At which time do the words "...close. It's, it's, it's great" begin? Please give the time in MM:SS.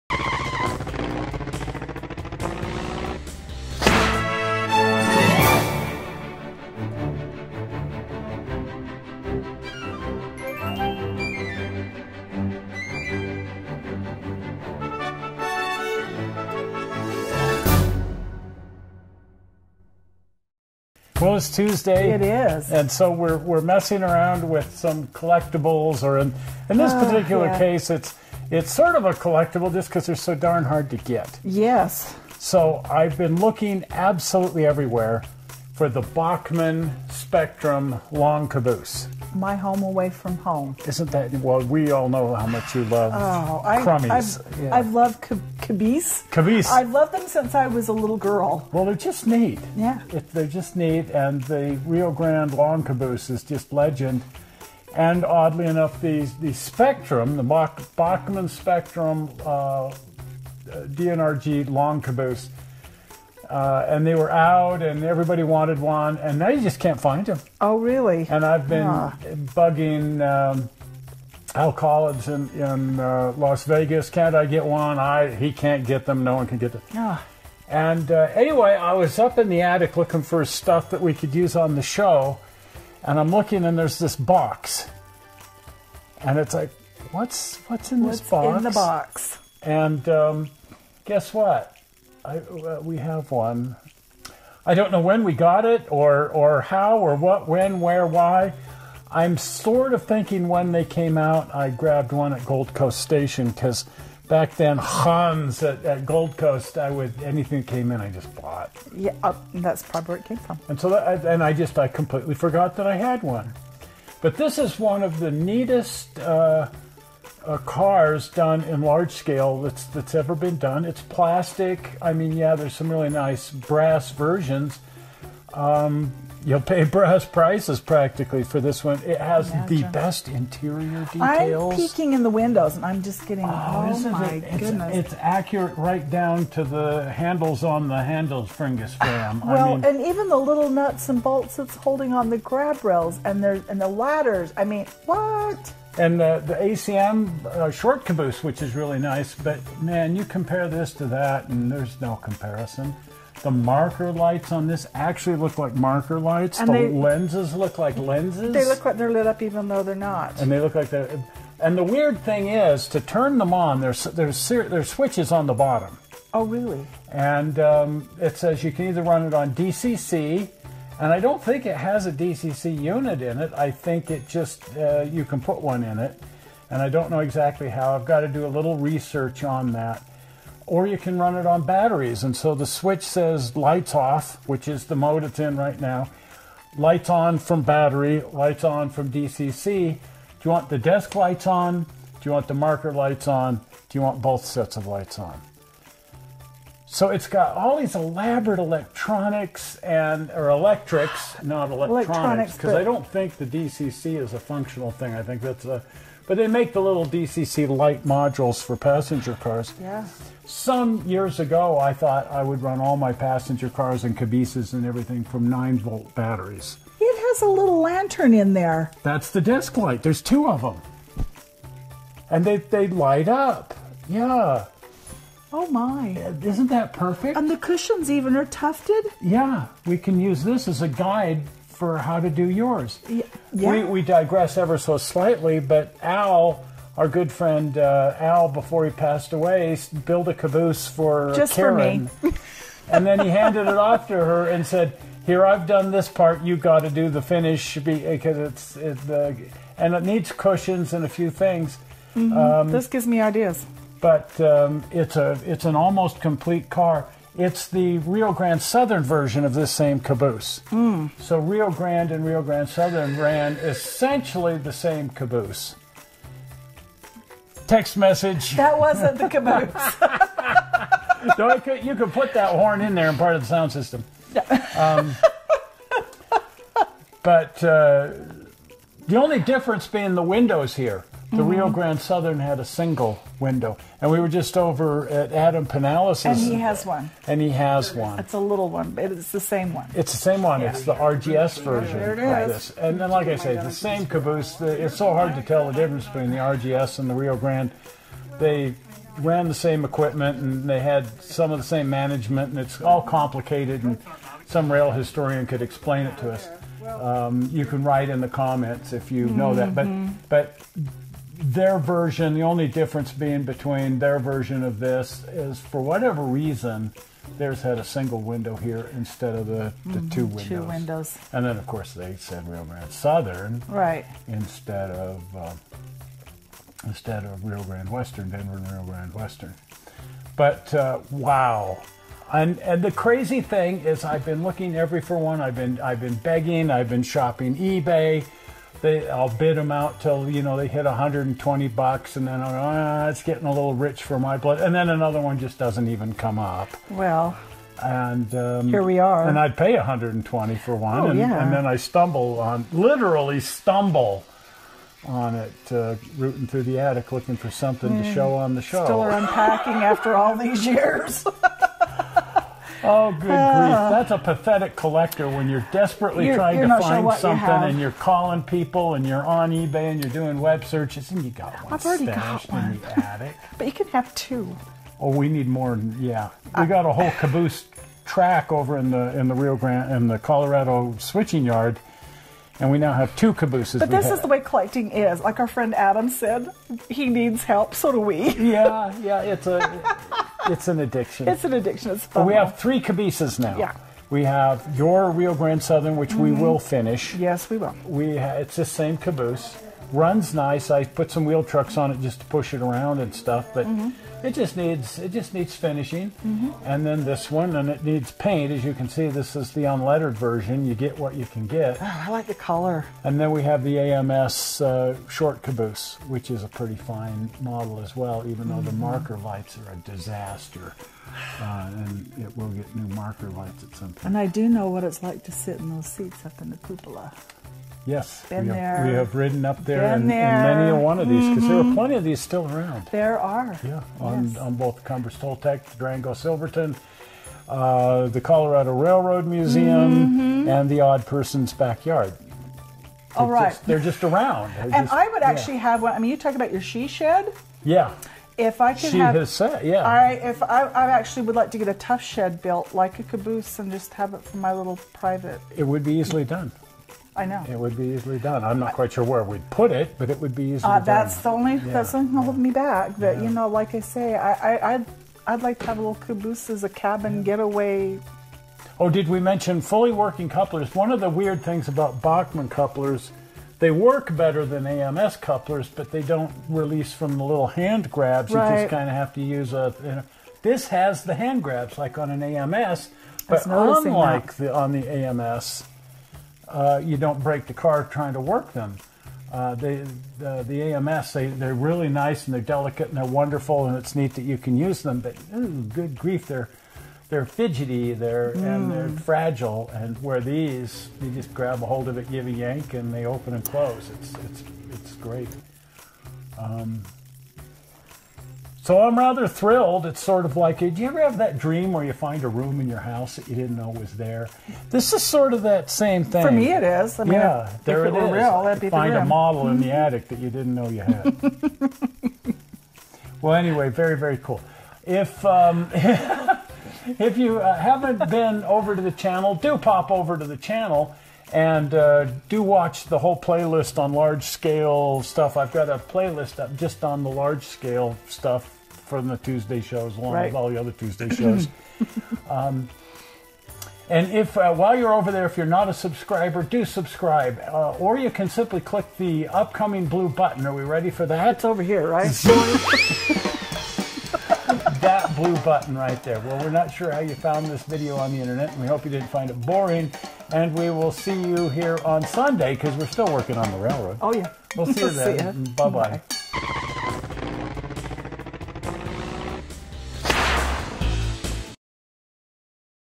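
08:23.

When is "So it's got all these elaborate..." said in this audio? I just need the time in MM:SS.
03:16.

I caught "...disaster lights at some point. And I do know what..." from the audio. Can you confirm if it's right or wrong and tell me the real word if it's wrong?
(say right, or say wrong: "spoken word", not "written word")
wrong: "marker", not "disaster".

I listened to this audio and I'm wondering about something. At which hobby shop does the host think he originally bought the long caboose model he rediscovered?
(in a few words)
Gold Coast Station.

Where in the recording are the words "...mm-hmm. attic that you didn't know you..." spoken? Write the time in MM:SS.
08:39.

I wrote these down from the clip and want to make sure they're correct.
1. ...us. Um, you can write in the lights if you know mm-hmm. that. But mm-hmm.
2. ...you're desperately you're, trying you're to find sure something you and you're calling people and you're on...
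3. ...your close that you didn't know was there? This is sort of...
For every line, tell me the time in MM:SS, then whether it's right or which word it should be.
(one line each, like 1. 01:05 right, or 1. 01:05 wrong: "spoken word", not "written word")
1. 05:06 wrong: "comments", not "lights"
2. 06:05 right
3. 08:32 wrong: "house", not "close".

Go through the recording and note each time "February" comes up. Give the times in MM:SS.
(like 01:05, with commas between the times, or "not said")
not said.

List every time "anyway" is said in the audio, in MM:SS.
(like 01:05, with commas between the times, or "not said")
01:18, 08:43.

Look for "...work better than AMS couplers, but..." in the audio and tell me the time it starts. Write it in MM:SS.
07:53.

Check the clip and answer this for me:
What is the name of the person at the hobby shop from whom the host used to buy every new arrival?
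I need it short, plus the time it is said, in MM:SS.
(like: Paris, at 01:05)
Hans, at 01:44.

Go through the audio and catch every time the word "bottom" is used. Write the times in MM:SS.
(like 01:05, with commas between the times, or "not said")
02:45.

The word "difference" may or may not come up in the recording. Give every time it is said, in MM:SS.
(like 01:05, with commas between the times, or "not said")
04:39, 04:55, 05:12.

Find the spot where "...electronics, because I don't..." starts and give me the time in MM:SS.
03:21.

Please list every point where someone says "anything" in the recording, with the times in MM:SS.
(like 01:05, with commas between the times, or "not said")
01:47.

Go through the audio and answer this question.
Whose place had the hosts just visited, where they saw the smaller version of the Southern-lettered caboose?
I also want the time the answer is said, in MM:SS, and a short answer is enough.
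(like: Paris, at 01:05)
Adam Pinales, at 04:45.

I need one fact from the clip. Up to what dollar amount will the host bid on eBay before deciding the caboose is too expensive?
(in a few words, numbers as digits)
120.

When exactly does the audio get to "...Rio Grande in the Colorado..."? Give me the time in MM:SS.
06:19.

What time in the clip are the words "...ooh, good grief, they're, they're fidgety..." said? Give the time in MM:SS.
08:15.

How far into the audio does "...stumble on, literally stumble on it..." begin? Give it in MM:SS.
05:51.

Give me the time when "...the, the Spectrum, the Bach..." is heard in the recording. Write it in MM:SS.
00:56.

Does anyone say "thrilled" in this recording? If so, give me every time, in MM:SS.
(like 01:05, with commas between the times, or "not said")
08:29.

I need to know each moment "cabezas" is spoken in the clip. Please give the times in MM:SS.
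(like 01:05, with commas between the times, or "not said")
03:34, 06:32.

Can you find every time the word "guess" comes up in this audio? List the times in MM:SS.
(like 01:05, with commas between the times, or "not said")
01:31.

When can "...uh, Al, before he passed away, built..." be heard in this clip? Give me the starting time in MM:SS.
03:57.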